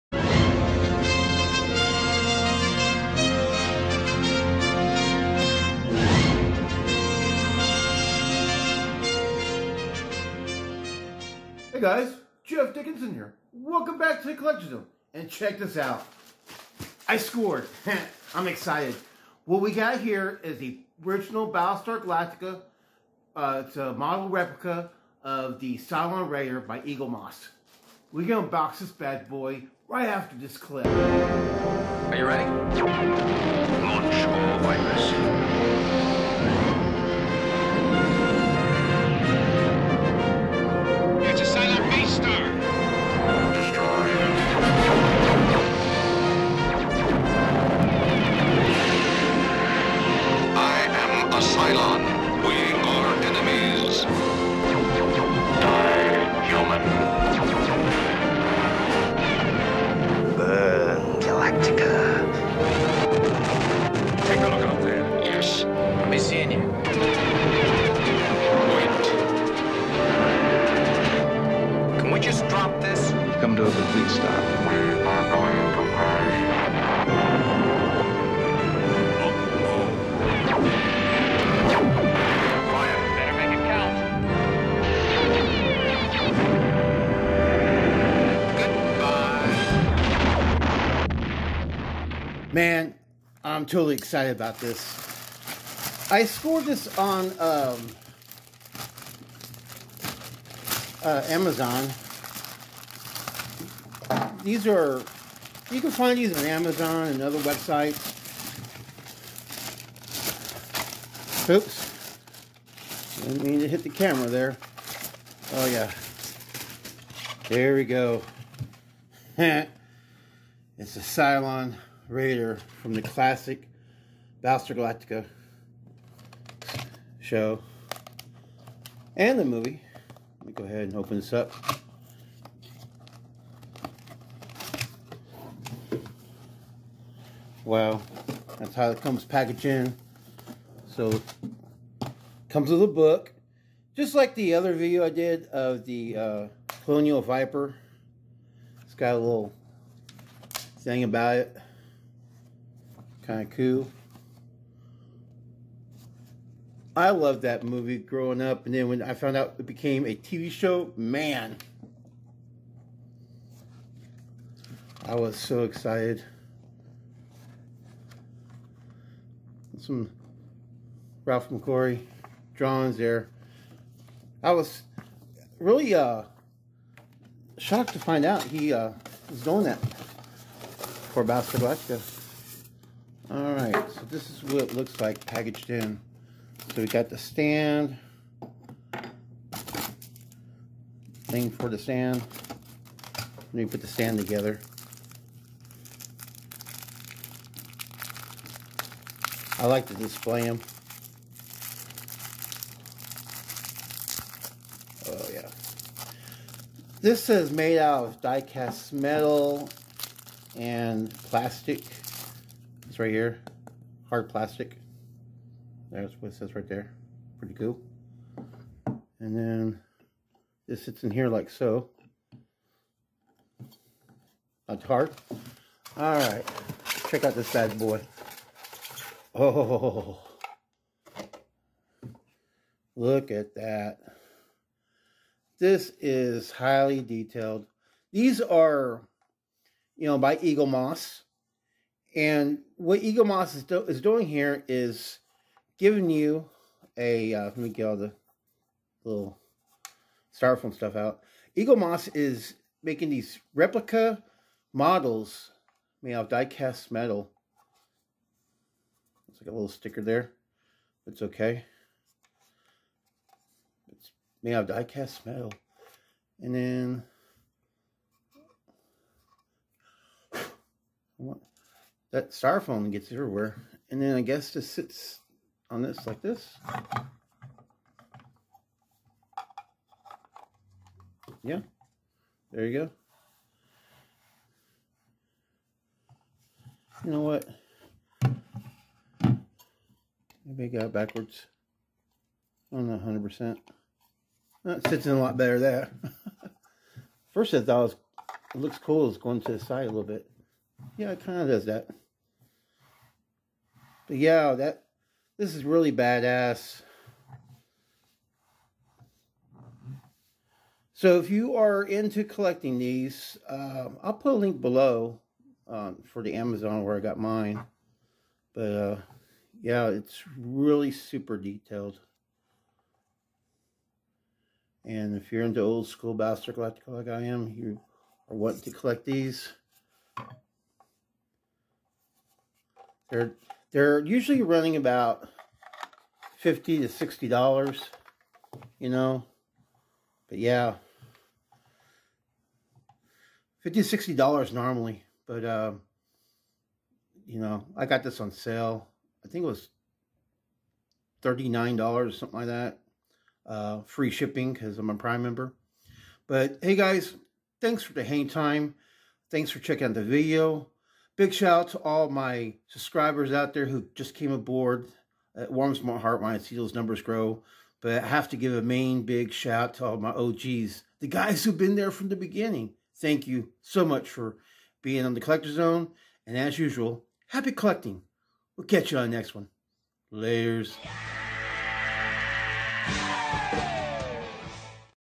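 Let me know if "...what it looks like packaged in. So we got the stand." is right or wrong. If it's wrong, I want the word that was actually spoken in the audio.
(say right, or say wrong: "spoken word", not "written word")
right.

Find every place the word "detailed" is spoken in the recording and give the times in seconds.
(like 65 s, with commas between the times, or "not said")
237 s, 321 s.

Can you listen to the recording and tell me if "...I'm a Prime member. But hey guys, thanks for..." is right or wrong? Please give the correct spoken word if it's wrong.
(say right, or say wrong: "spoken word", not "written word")
right.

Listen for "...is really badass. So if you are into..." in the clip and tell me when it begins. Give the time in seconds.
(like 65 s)
305 s.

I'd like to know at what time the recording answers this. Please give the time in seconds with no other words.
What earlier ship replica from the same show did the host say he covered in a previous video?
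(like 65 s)
146 s.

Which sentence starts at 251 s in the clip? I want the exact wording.
Eaglemoss is making these replica models made out of die-cast metal like a little sticker there.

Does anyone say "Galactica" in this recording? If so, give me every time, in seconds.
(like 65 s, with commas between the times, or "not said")
22 s, 124 s, 181 s, 326 s.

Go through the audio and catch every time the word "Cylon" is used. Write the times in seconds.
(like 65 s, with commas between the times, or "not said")
25 s, 121 s.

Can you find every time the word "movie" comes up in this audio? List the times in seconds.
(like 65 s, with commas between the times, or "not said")
129 s, 157 s.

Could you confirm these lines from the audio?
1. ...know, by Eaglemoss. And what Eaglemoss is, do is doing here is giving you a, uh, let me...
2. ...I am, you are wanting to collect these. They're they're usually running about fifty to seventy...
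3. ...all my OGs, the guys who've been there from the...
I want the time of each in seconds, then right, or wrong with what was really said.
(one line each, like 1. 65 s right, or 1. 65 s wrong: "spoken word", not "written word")
1. 240 s right
2. 327 s wrong: "sixty", not "seventy"
3. 369 s right.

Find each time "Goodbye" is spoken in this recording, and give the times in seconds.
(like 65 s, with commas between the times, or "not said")
92 s.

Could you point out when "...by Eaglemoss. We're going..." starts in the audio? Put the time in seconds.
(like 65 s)
26 s.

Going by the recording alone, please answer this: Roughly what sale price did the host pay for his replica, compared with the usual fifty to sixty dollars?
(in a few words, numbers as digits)
$39.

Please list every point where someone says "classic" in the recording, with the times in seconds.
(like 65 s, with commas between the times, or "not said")
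123 s.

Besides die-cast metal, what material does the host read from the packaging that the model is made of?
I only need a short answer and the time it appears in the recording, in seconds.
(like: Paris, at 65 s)
Hard plastic, at 214 s.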